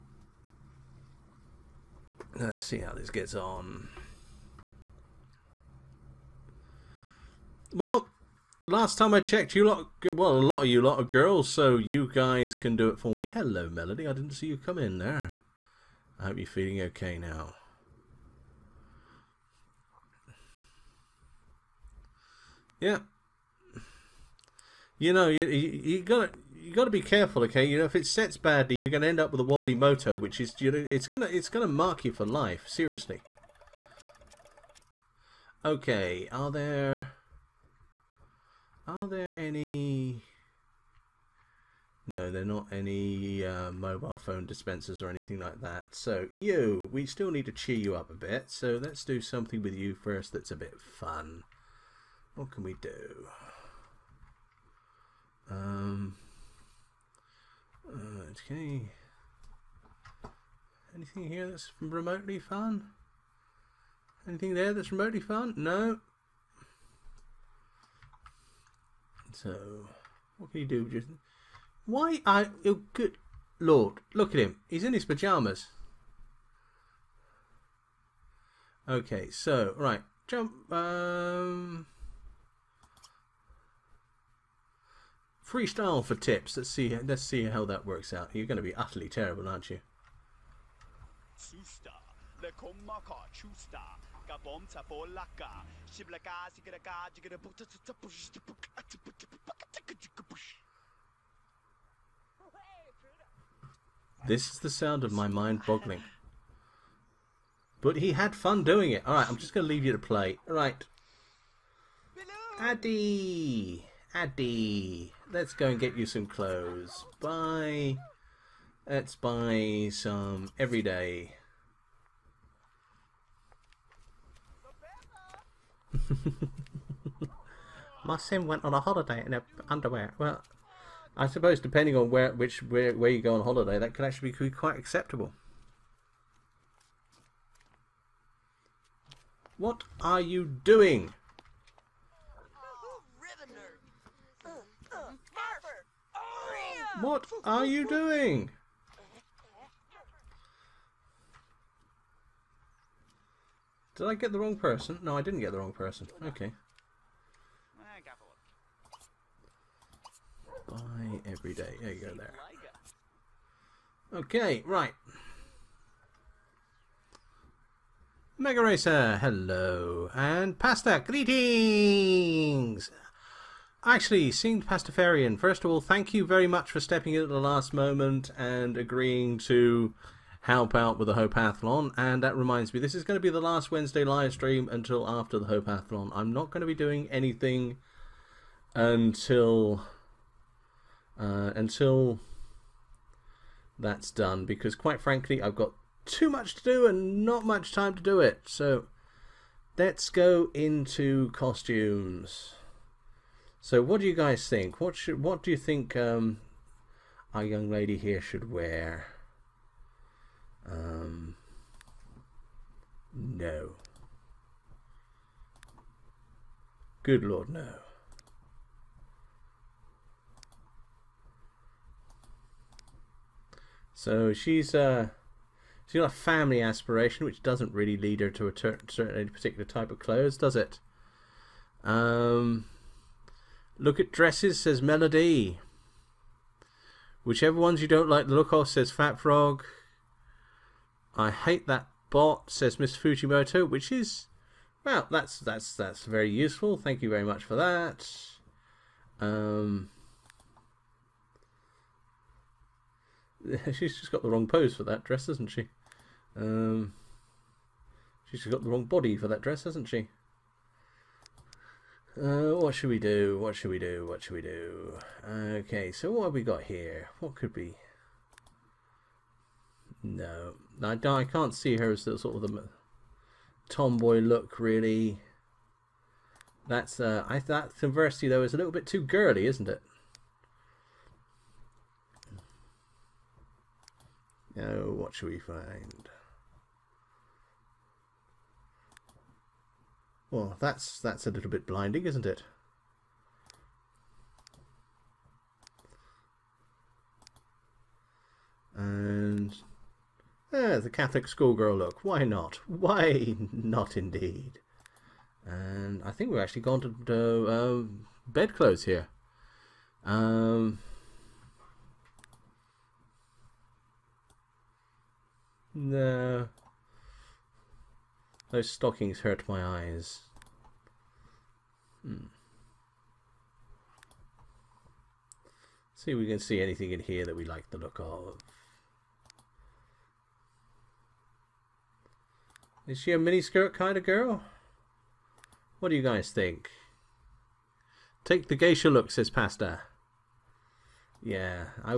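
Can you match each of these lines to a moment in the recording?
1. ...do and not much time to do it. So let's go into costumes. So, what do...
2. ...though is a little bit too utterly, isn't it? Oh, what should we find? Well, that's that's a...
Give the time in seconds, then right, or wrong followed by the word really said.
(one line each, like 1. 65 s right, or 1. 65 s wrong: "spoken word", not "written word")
1. 196 s right
2. 278 s wrong: "girly", not "utterly".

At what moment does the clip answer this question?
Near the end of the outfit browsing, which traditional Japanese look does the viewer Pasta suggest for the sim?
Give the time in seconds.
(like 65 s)
338 s.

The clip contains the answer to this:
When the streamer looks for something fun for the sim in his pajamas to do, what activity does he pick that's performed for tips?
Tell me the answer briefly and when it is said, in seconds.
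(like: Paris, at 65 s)
Freestyle, at 85 s.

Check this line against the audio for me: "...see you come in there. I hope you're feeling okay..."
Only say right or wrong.
right.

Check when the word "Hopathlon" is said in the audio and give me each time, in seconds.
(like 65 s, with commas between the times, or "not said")
181 s, 185 s.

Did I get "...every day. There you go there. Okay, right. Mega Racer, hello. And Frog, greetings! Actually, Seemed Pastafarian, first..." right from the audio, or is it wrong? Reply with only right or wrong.
wrong.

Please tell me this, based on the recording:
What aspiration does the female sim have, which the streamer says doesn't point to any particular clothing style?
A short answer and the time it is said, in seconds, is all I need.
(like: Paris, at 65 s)
Family, at 226 s.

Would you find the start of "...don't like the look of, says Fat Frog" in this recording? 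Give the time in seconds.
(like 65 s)
237 s.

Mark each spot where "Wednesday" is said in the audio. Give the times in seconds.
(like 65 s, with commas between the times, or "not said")
183 s.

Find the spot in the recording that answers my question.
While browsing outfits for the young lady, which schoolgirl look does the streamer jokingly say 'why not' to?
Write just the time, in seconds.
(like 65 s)
300 s.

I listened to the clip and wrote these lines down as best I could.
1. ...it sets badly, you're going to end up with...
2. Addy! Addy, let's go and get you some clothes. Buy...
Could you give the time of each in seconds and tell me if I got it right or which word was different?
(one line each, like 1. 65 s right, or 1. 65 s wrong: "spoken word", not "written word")
1. 27 s right
2. 112 s right.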